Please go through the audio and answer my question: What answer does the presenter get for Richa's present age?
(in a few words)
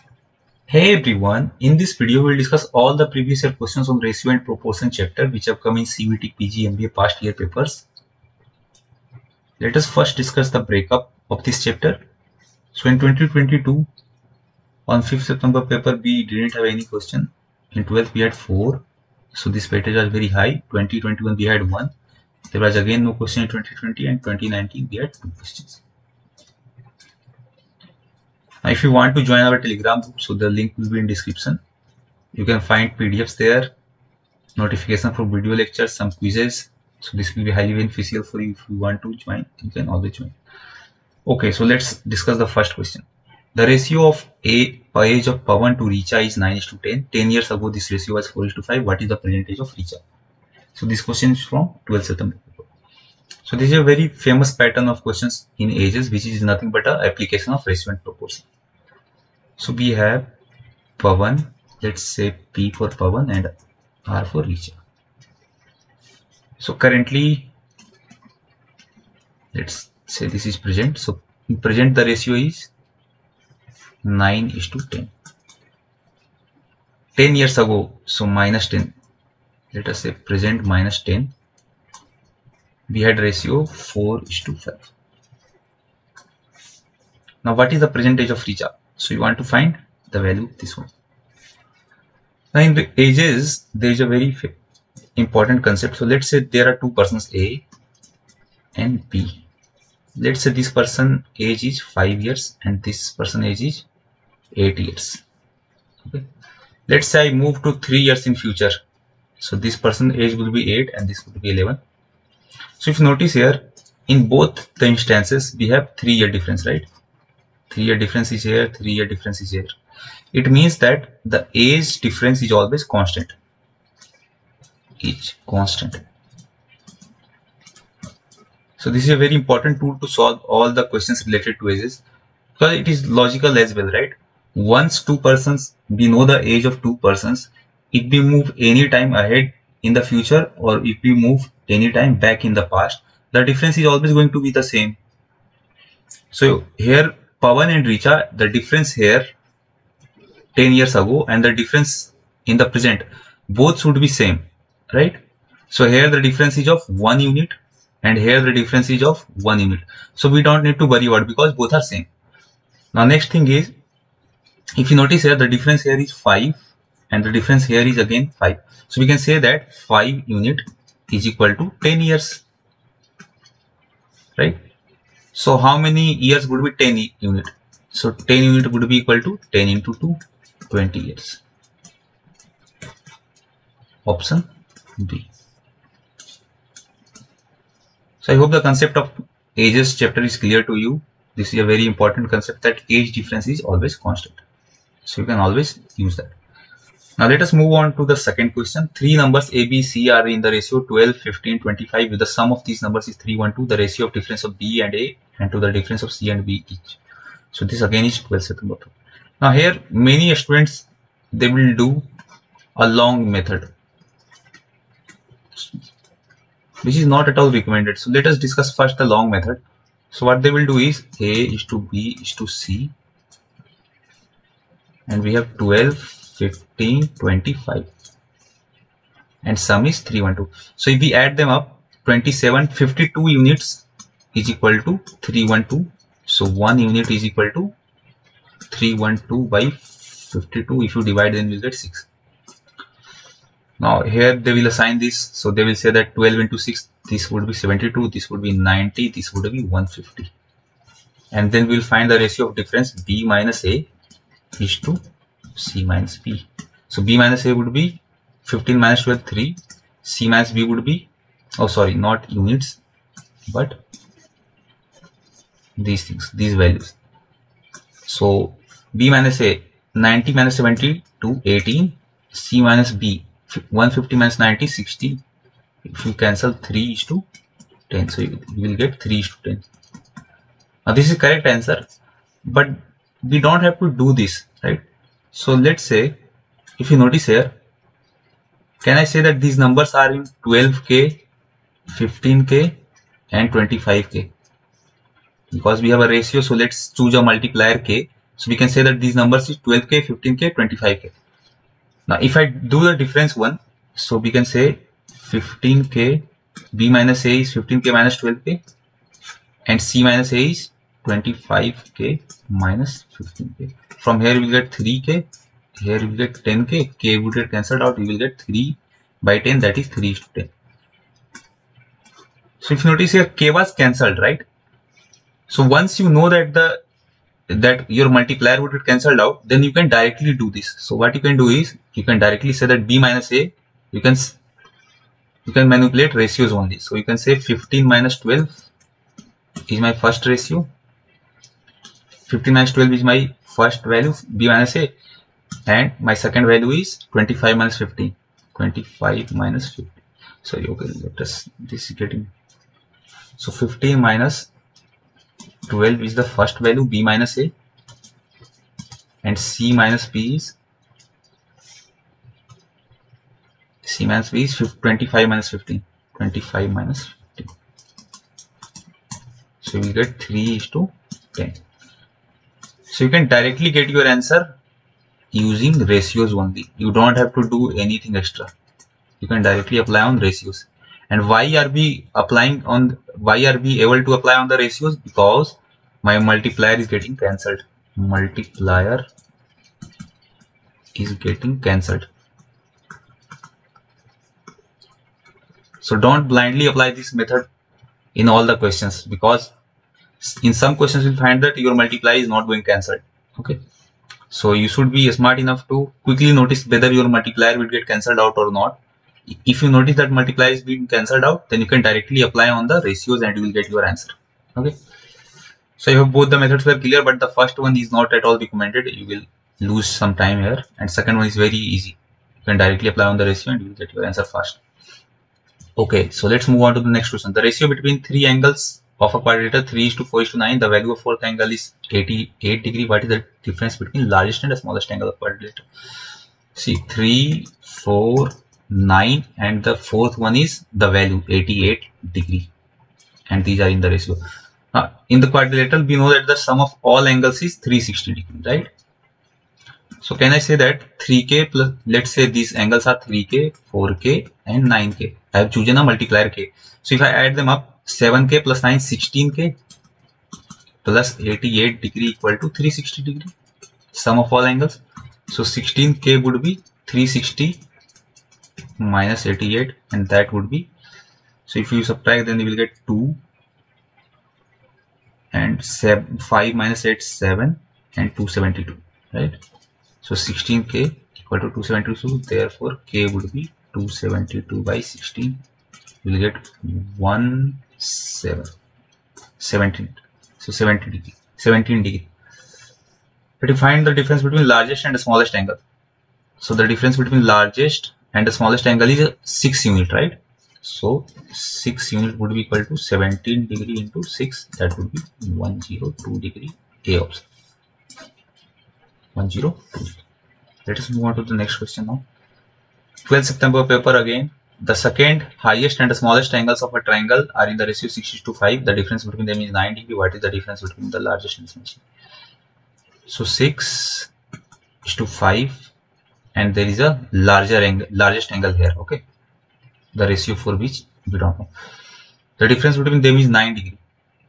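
20 years.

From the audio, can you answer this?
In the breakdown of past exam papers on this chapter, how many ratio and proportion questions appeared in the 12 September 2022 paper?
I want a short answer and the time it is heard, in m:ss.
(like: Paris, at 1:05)
4, at 0:17.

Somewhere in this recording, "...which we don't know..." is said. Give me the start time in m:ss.
8:50.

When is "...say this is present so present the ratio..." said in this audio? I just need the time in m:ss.
1:10.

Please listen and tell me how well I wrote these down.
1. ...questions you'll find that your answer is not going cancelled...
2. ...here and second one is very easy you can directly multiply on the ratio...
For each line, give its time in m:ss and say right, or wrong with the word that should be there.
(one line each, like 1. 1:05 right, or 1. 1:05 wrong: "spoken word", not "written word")
1. 6:40 wrong: "multiplier", not "answer"
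2. 7:00 wrong: "apply", not "multiply".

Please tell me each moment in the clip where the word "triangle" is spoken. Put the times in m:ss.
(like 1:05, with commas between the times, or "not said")
8:36.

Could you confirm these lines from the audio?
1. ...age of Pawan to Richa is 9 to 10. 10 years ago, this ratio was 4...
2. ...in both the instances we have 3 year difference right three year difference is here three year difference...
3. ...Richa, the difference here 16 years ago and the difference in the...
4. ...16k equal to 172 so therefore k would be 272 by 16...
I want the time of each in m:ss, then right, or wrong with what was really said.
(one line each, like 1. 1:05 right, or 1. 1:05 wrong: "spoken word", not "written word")
1. 0:45 right
2. 1:54 right
3. 2:27 wrong: "10", not "16"
4. 8:00 wrong: "272", not "172".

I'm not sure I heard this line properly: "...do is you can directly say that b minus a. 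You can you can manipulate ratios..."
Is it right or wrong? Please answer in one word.
right.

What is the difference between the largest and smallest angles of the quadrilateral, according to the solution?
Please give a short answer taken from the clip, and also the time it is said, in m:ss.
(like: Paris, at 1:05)
102 degrees, at 8:25.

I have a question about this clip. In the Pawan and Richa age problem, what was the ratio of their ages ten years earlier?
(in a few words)
4 to 5.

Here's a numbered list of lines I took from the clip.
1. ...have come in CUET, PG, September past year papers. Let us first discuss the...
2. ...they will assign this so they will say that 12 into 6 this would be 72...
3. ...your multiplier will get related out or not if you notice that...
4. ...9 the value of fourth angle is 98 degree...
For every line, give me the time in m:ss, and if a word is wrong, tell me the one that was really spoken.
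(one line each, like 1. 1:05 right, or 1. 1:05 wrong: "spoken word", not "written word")
1. 0:05 wrong: "MBA", not "September"
2. 4:04 right
3. 6:46 wrong: "cancelled", not "related"
4. 7:10 wrong: "88", not "98".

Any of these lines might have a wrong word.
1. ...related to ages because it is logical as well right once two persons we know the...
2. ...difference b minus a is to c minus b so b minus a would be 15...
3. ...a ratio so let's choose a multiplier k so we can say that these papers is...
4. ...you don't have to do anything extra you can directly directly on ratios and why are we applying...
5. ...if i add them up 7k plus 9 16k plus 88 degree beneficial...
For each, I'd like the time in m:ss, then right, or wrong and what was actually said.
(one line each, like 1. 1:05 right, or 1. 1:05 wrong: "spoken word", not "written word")
1. 2:11 right
2. 4:12 right
3. 4:56 wrong: "numbers", not "papers"
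4. 6:16 wrong: "apply", not "directly"
5. 7:36 wrong: "equal", not "beneficial".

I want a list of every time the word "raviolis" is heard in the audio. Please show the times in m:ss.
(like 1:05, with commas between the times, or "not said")
not said.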